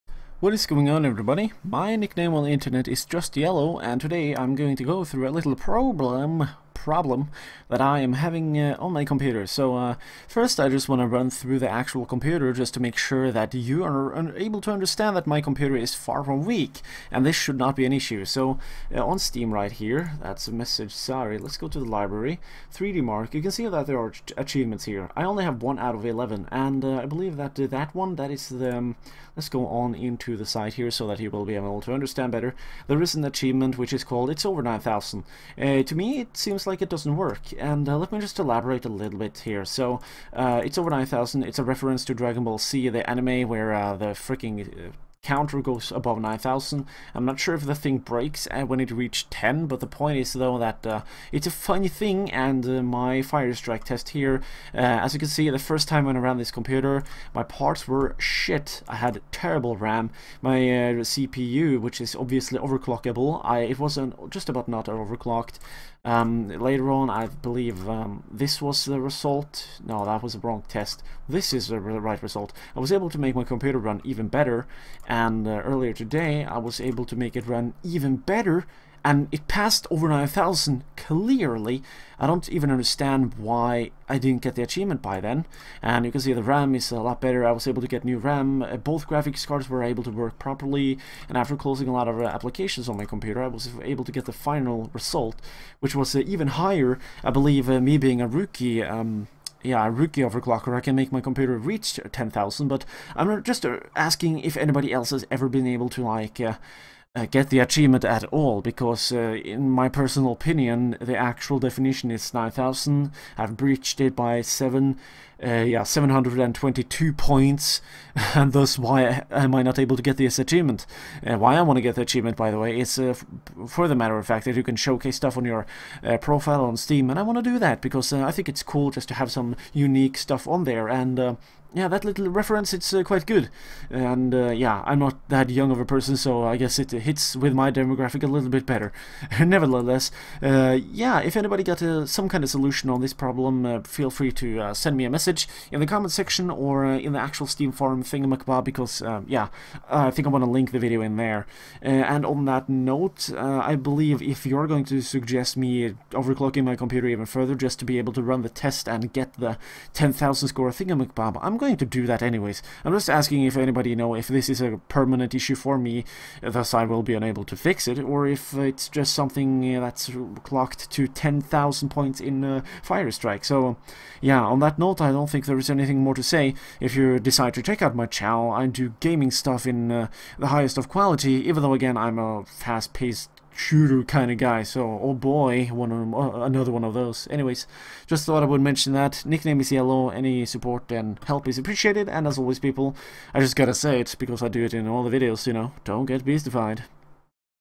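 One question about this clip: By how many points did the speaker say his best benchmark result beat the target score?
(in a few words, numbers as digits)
722.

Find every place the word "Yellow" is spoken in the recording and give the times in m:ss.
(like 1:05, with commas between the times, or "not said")
0:03, 3:09.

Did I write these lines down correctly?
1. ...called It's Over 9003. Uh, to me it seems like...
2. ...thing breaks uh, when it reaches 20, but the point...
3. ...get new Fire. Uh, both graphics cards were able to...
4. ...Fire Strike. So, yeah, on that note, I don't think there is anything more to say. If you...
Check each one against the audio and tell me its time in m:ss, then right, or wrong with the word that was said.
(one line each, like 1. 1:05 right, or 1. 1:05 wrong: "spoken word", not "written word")
1. 0:34 wrong: "9000", not "9003"
2. 0:47 wrong: "10", not "20"
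3. 1:27 wrong: "RAM", not "Fire"
4. 2:52 right.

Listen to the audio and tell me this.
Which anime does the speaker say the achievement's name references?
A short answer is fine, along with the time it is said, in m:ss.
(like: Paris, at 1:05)
Dragon Ball Z, at 0:42.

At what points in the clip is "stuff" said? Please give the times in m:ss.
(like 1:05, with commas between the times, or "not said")
2:05, 2:10, 2:59.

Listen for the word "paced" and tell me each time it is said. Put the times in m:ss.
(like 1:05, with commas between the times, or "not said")
3:02.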